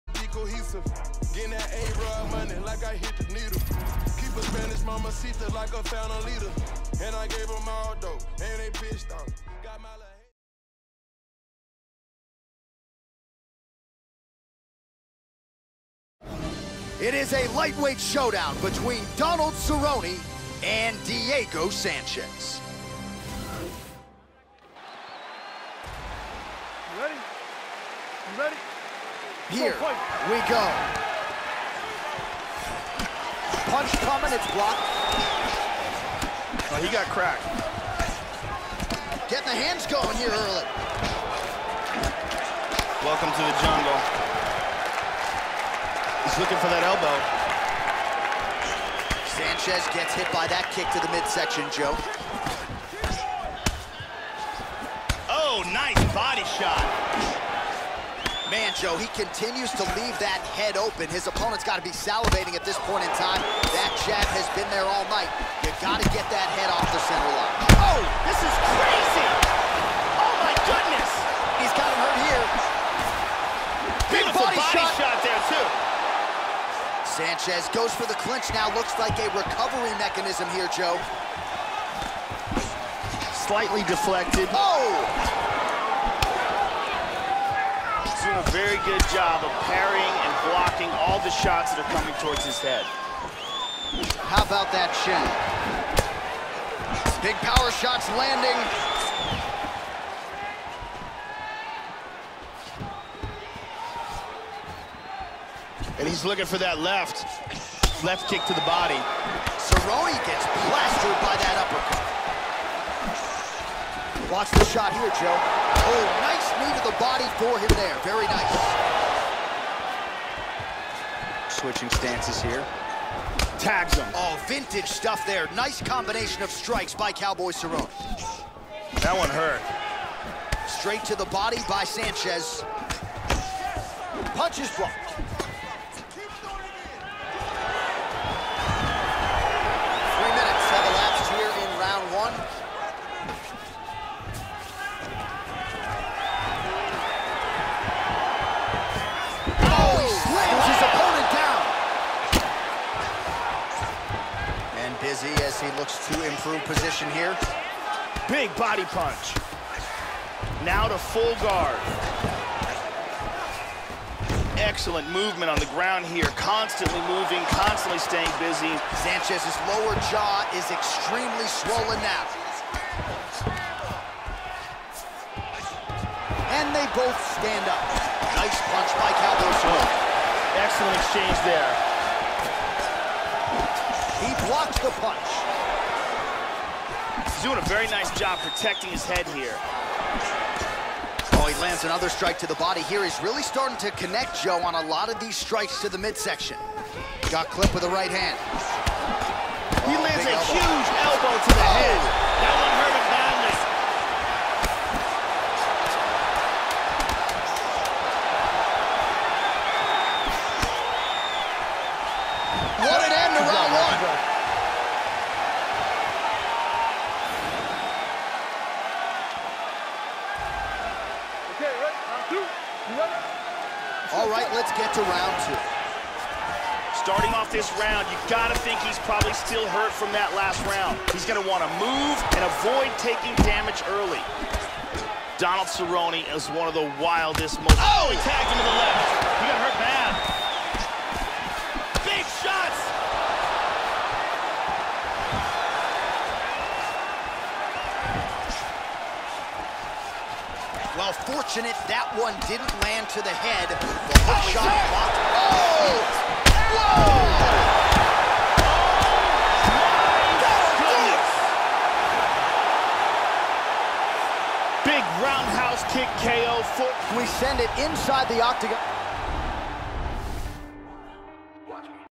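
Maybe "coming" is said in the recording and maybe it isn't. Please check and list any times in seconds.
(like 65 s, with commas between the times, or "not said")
34 s, 91 s.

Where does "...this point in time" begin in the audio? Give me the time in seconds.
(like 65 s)
62 s.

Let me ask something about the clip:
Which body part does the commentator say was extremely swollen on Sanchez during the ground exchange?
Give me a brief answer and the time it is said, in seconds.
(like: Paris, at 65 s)
Lower jaw, at 169 s.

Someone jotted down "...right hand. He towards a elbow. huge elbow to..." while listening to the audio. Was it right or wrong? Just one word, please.
wrong.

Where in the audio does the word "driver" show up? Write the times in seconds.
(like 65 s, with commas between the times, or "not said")
not said.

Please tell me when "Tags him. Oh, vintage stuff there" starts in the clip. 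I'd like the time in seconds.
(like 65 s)
123 s.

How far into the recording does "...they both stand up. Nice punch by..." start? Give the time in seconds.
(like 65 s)
176 s.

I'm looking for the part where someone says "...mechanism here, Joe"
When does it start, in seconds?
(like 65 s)
79 s.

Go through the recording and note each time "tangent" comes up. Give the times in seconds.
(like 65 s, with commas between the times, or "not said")
not said.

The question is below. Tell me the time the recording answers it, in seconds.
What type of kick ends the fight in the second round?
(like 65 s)
265 s.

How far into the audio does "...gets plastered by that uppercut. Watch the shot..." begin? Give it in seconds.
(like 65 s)
110 s.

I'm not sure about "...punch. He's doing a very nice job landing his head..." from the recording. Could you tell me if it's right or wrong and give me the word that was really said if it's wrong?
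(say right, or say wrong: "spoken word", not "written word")
wrong: "protecting", not "landing".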